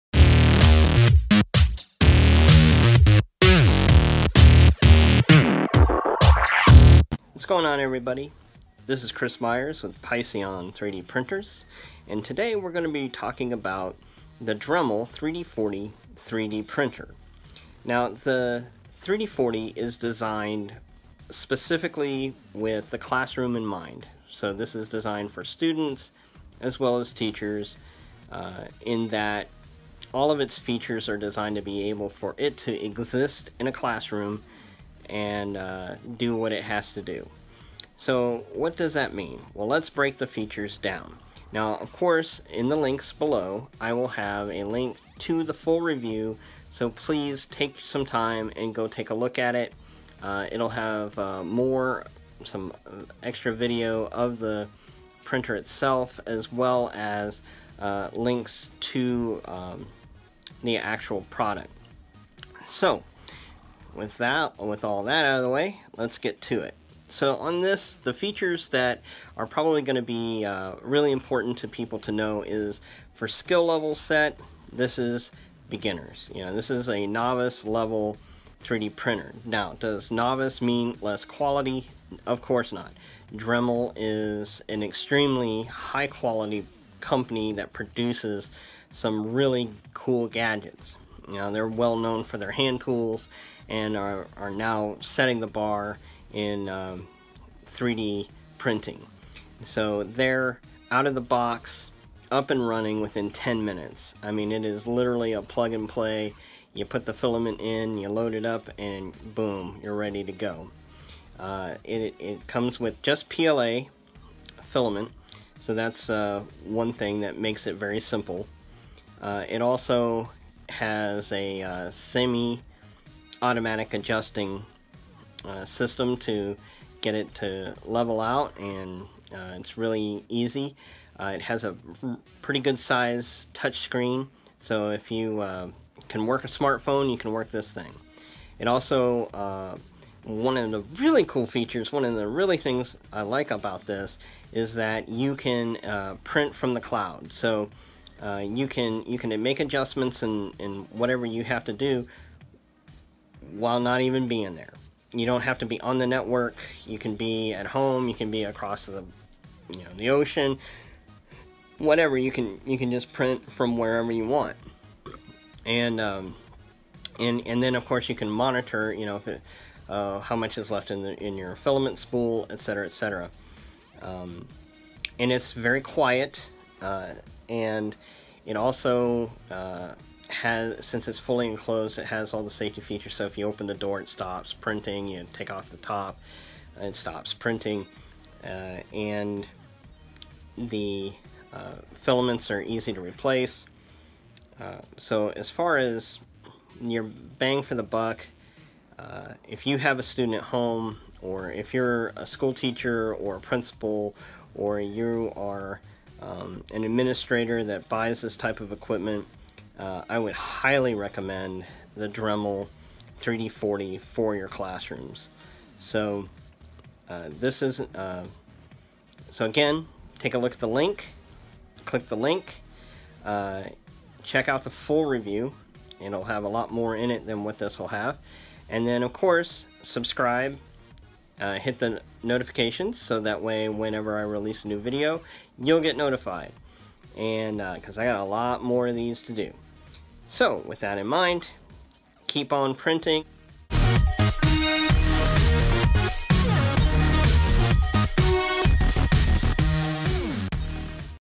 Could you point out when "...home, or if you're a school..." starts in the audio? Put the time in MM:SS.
03:20.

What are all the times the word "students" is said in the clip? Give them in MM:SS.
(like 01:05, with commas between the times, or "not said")
00:25, 03:20.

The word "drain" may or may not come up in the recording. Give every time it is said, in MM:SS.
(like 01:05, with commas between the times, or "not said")
not said.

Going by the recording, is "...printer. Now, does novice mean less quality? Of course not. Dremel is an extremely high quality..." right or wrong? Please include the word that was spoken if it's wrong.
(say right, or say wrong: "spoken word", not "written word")
right.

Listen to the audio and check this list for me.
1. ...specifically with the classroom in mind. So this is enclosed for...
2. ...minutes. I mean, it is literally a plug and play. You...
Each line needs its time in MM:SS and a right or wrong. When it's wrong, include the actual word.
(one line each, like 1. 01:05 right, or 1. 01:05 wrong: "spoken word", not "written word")
1. 00:21 wrong: "designed", not "enclosed"
2. 01:43 right.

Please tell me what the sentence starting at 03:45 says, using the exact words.
It'll have a lot more in it than what this will have.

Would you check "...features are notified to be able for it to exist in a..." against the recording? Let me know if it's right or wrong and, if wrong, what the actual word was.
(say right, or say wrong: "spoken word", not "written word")
wrong: "designed", not "notified".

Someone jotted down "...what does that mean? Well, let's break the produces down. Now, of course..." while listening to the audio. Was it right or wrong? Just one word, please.
wrong.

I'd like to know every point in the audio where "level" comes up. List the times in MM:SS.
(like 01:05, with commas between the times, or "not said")
01:13, 01:17, 02:07.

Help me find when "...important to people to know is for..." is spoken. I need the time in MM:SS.
01:11.